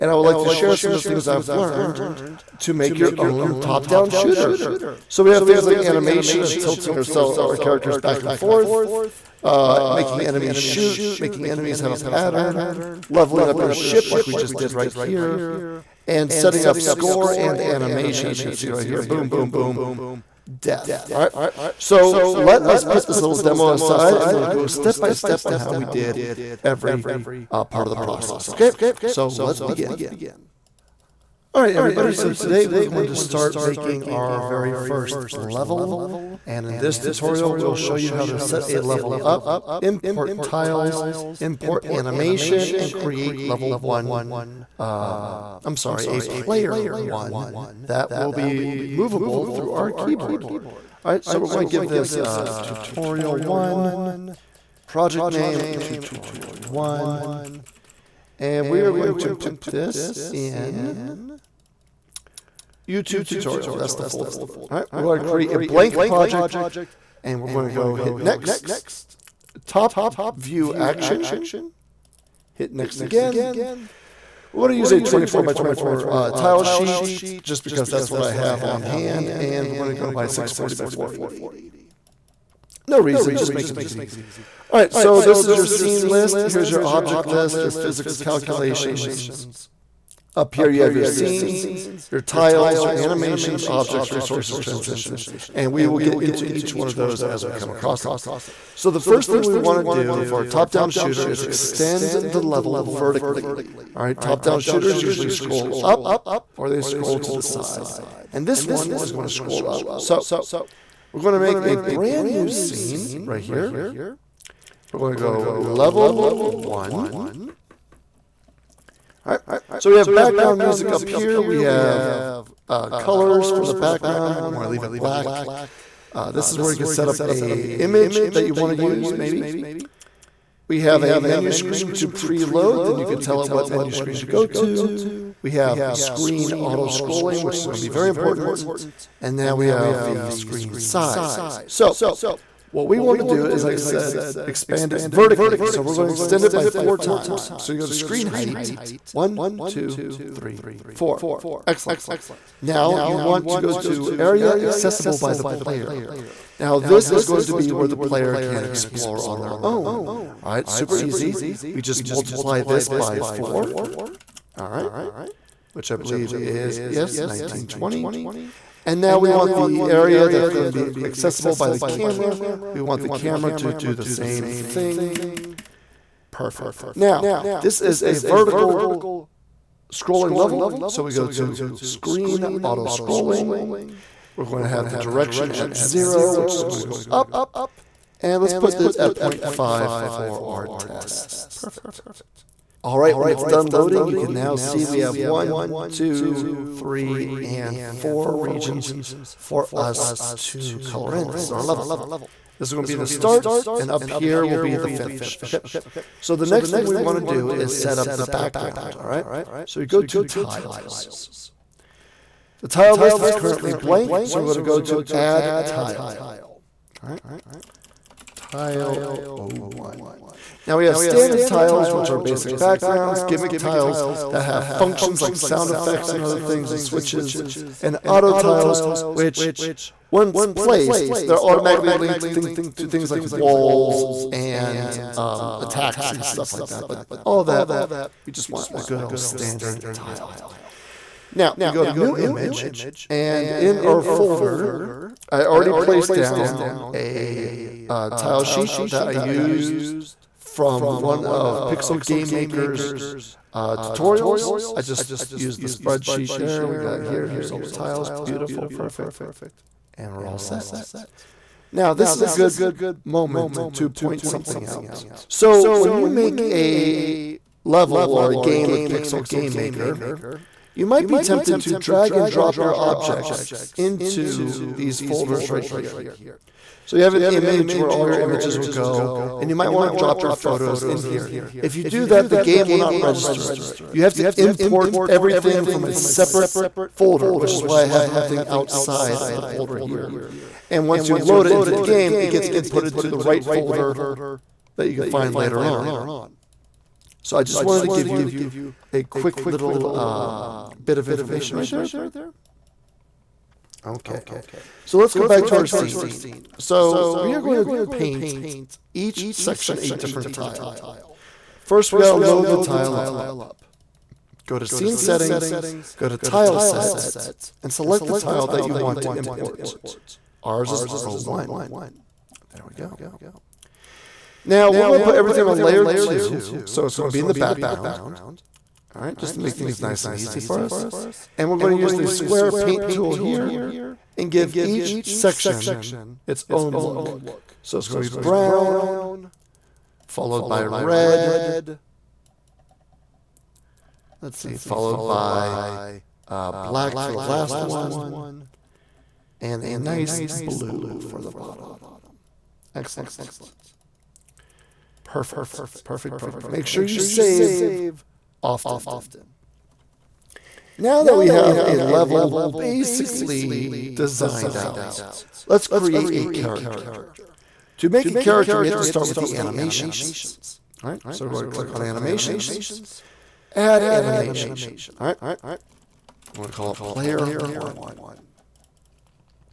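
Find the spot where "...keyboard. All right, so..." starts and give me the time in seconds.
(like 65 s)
49 s.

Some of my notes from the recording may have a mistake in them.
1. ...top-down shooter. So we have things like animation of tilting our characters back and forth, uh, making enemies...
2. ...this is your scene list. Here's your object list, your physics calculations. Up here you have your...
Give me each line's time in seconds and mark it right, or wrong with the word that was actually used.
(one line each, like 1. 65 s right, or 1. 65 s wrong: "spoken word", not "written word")
1. 3 s right
2. 85 s right.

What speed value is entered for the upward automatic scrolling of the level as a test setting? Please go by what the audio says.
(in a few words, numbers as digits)
0.5.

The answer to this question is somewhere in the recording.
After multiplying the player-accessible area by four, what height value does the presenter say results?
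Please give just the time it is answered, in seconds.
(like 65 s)
167 s.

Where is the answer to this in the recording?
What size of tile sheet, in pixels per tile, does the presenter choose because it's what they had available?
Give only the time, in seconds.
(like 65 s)
75 s.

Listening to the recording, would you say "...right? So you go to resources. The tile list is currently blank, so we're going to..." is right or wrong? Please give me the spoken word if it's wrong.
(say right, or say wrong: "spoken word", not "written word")
wrong: "tiles", not "resources".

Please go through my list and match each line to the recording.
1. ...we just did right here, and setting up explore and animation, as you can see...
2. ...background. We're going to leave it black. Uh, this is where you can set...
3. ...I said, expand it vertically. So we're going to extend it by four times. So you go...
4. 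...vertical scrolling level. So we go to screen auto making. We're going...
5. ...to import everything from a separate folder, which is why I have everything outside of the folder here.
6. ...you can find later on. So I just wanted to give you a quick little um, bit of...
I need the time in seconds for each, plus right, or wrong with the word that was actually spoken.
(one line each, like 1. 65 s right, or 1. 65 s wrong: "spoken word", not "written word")
1. 14 s wrong: "score", not "explore"
2. 123 s right
3. 143 s right
4. 178 s wrong: "scrolling", not "making"
5. 284 s right
6. 294 s right.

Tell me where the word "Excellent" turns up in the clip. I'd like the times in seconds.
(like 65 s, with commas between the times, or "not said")
151 s, 352 s.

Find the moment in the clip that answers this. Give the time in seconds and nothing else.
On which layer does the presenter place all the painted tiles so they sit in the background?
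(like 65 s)
325 s.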